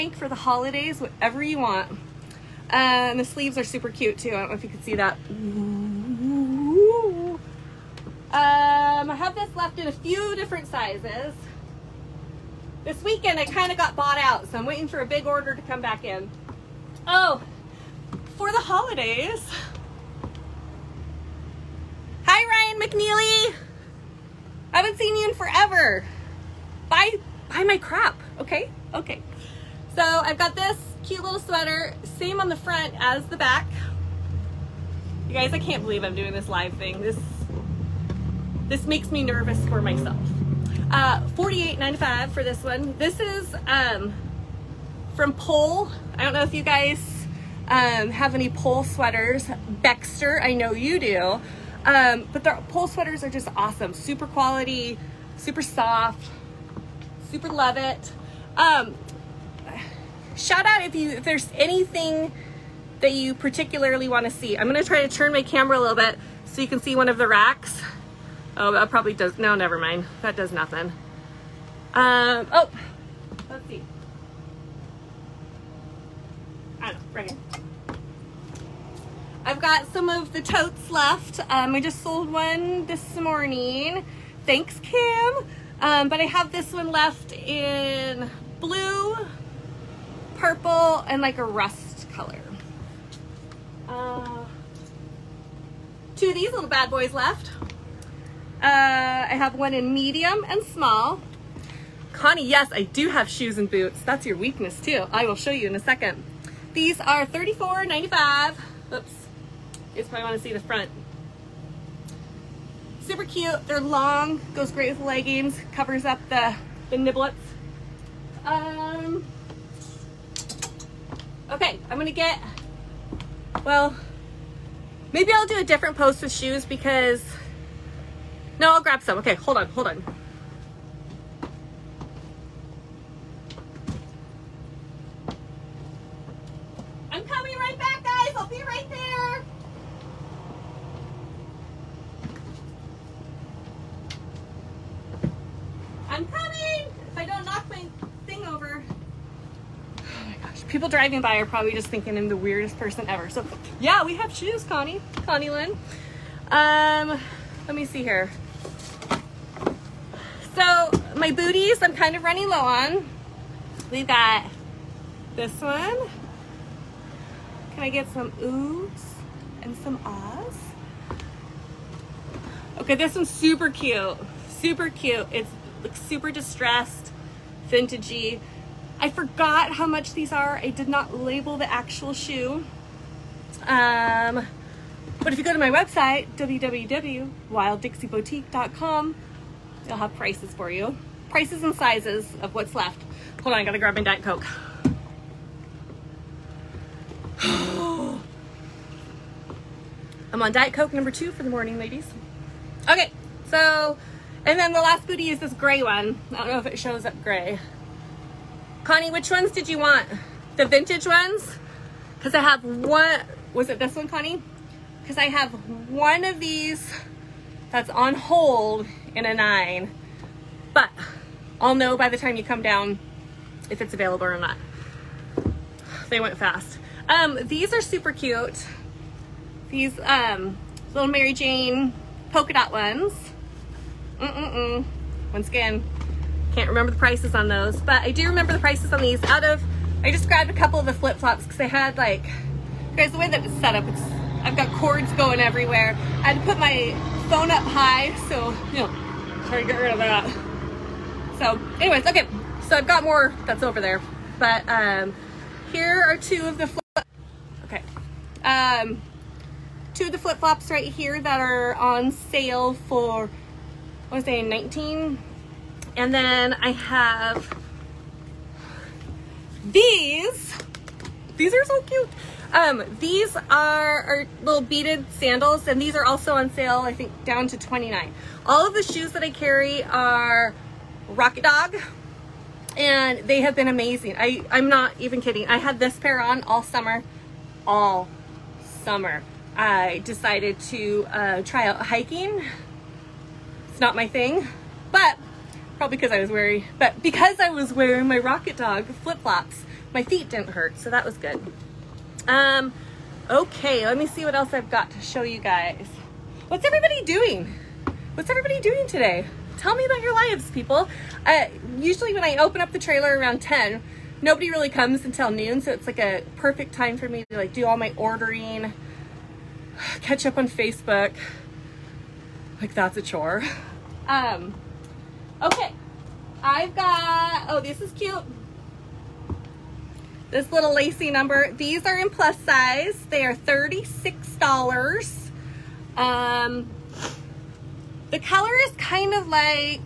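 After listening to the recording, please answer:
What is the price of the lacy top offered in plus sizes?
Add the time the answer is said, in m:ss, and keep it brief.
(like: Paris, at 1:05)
$36, at 5:33.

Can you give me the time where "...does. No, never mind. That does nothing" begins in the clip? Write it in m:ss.
1:09.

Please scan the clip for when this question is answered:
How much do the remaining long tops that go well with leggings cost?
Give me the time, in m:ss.
1:47.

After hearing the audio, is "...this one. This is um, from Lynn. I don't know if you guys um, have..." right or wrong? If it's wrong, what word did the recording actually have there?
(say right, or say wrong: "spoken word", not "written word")
wrong: "Pole", not "Lynn".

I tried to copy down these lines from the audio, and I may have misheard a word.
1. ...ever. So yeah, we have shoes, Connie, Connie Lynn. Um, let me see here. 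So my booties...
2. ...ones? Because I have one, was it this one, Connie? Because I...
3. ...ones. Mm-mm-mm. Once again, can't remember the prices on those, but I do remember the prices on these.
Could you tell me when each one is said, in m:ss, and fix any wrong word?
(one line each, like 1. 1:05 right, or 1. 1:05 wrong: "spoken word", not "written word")
1. 2:33 right
2. 3:31 right
3. 3:52 right.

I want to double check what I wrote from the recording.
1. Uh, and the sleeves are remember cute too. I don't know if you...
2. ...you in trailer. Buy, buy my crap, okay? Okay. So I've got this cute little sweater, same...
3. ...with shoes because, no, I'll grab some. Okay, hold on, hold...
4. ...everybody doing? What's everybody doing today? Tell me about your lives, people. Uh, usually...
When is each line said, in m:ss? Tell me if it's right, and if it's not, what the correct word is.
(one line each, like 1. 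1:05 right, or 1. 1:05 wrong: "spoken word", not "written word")
1. 0:02 wrong: "super", not "remember"
2. 0:25 wrong: "forever", not "trailer"
3. 2:06 right
4. 5:06 right.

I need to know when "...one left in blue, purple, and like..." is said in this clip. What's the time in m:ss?
1:26.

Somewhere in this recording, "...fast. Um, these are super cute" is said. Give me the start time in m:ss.
3:46.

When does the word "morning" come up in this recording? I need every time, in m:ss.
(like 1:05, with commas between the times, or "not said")
1:23, 3:21.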